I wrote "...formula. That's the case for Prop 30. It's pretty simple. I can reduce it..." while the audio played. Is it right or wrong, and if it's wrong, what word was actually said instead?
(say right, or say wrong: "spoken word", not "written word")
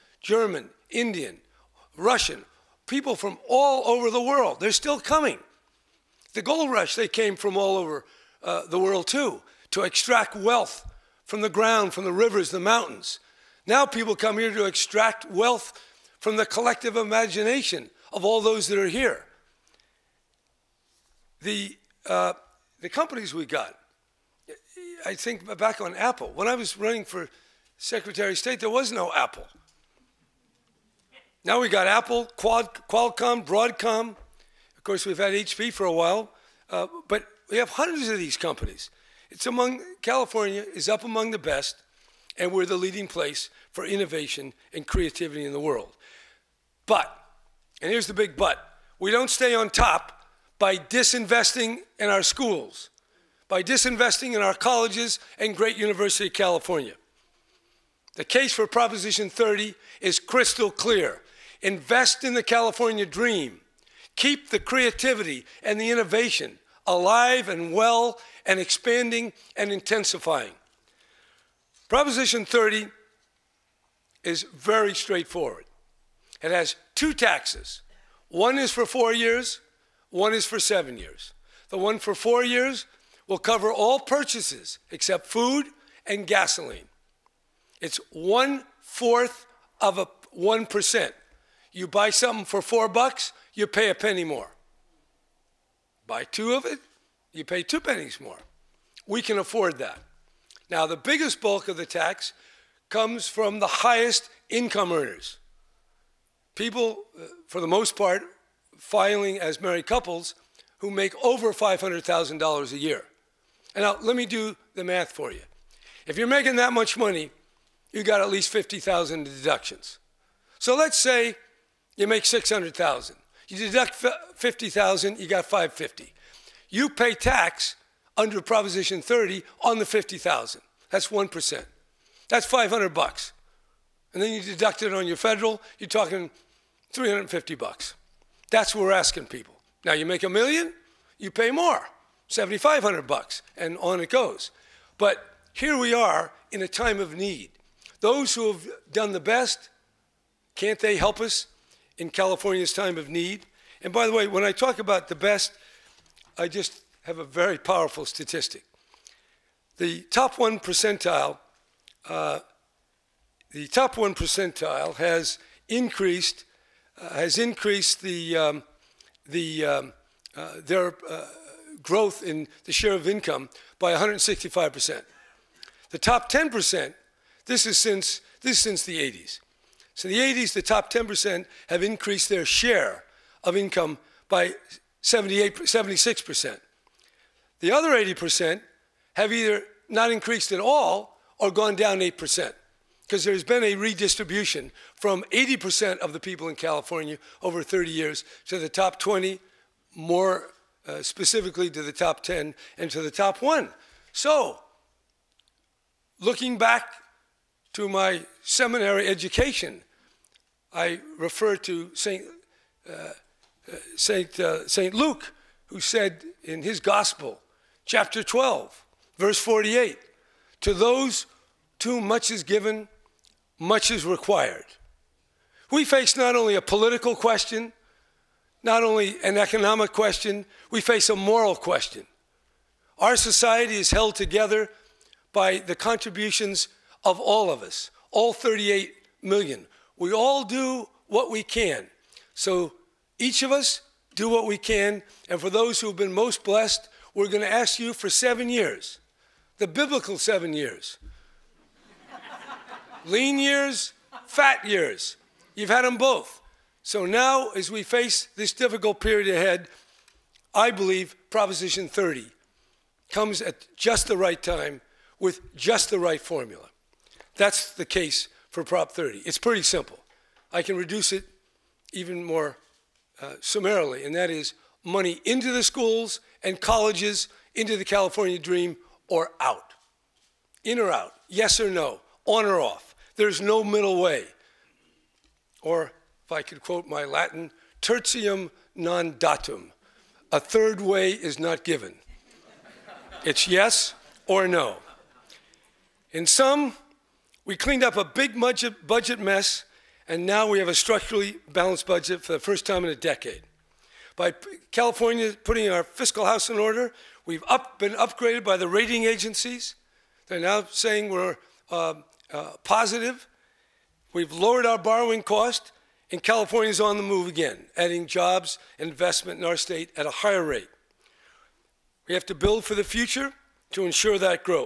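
right.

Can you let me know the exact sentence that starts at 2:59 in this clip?
So in the 80s, the top 10% have increased their share of income by 78, 76%.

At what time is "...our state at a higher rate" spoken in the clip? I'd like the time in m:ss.
5:19.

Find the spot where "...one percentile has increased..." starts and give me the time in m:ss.
2:43.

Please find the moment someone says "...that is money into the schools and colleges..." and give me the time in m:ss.
4:34.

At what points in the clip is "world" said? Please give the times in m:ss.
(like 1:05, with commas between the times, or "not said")
0:04, 0:08, 0:45.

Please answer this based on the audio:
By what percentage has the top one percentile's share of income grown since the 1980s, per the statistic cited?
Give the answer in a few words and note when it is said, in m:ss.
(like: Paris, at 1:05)
165%, at 2:53.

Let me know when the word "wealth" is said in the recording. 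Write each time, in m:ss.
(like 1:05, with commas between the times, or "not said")
0:10, 0:15.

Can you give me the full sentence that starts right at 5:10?
They're now saying we're uh, uh, positive.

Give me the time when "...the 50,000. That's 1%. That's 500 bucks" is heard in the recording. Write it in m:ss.
2:09.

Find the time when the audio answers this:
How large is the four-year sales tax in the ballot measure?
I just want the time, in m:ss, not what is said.
1:28.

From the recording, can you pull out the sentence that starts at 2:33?
And by the way, when I talk about the best, I just have a very powerful statistic.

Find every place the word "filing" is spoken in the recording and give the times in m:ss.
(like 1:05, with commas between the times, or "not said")
1:48.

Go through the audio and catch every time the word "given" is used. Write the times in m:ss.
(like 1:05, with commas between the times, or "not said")
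3:42, 4:51.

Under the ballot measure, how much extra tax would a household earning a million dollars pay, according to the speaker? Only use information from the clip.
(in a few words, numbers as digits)
$7,500.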